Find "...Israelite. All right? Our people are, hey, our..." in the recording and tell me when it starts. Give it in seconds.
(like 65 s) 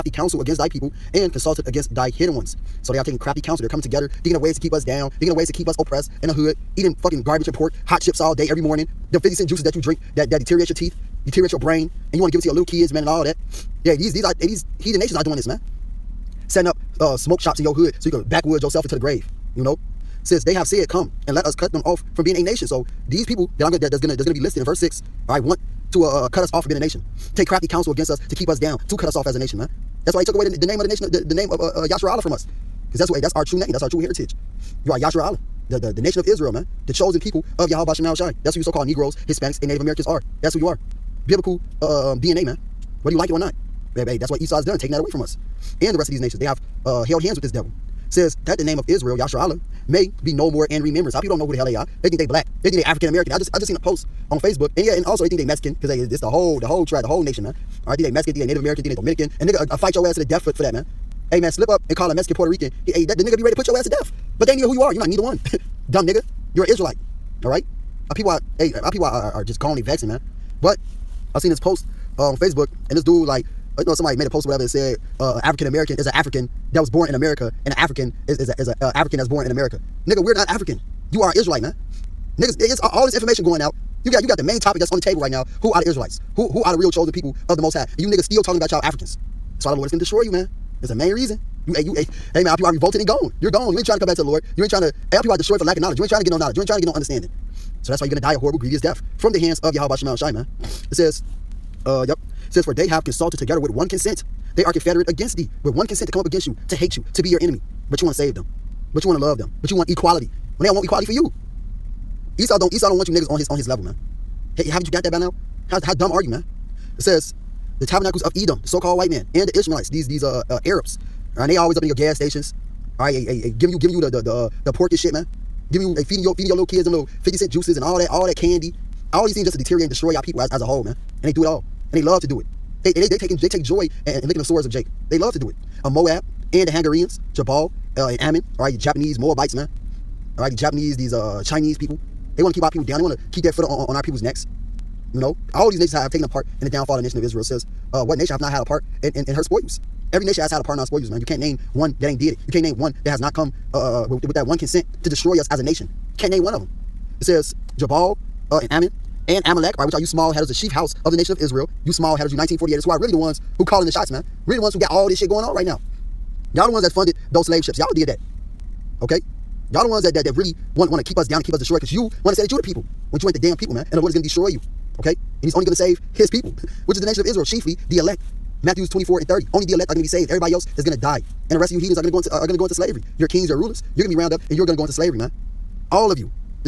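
66 s.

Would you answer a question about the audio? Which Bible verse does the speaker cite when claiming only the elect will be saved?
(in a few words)
Matthew 24:30.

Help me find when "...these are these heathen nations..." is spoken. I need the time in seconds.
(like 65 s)
14 s.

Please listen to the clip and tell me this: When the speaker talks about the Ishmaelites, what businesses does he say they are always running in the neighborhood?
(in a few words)
gas stations.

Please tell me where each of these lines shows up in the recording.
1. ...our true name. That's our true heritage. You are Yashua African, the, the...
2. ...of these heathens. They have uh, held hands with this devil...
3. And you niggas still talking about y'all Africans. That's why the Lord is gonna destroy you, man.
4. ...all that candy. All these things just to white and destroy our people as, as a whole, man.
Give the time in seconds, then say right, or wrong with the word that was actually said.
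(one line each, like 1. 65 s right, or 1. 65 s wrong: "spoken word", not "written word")
1. 33 s wrong: "Allah", not "African"
2. 46 s wrong: "nations", not "heathens"
3. 87 s right
4. 128 s wrong: "deteriorate", not "white".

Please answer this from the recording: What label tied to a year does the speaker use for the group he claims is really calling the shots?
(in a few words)
1948ers.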